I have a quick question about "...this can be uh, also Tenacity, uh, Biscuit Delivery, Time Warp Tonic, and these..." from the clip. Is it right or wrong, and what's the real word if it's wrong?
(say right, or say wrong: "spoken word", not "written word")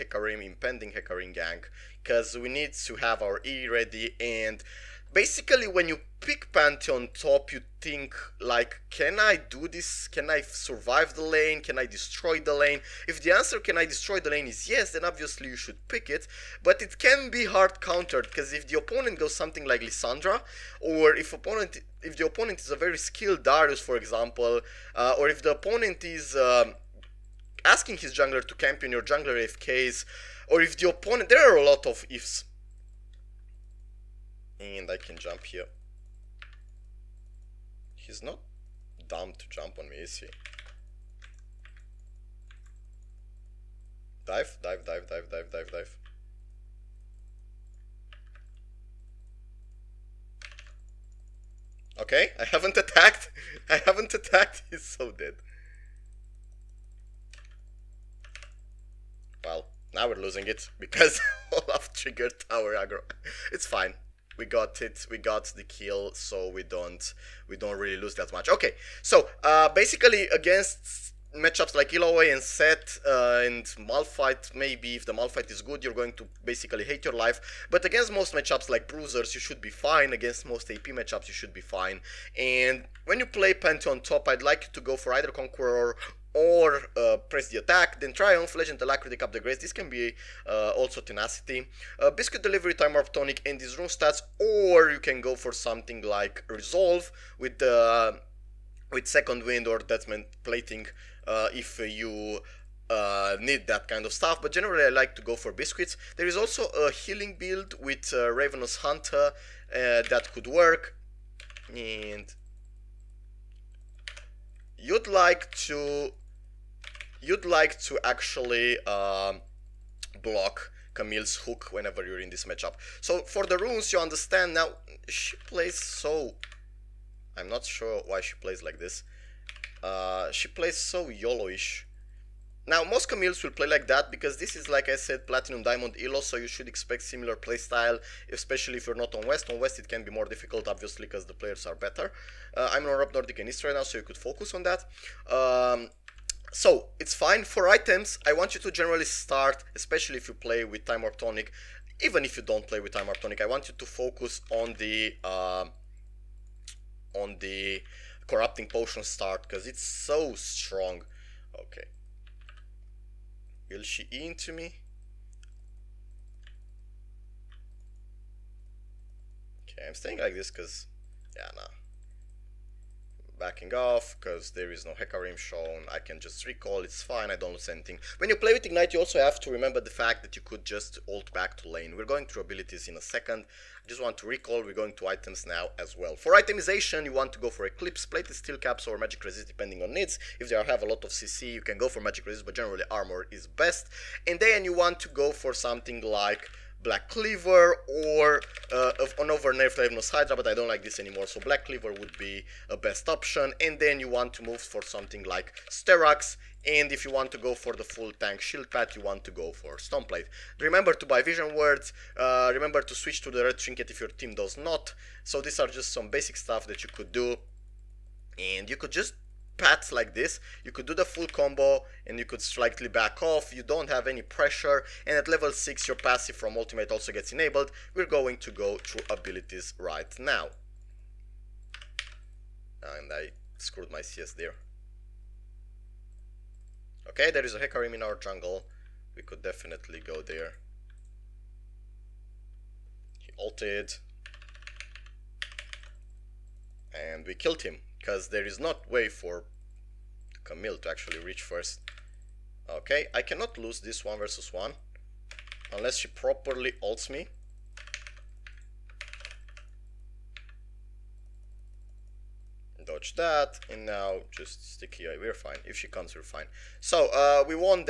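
right.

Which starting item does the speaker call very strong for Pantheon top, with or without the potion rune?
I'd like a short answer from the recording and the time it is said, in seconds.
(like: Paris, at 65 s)
Corrupting Potion, at 158 s.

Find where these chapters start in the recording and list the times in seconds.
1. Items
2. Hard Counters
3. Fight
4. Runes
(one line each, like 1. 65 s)
1. 150 s
2. 5 s
3. 230 s
4. 84 s.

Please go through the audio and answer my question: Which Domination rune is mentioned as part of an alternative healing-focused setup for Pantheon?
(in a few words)
Ravenous Hunter.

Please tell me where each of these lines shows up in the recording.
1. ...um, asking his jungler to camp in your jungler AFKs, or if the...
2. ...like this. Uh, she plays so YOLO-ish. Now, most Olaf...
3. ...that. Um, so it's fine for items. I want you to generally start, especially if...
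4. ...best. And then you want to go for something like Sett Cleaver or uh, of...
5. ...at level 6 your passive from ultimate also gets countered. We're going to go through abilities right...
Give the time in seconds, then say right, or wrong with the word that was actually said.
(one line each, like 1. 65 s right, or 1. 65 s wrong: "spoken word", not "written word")
1. 26 s right
2. 128 s wrong: "Camilles", not "Olaf"
3. 144 s right
4. 193 s wrong: "Black", not "Sett"
5. 225 s wrong: "enabled", not "countered".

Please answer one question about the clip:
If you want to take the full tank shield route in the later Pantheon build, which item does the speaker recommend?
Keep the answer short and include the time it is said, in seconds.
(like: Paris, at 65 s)
Stoneplate, at 209 s.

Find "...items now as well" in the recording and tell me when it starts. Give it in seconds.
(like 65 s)
185 s.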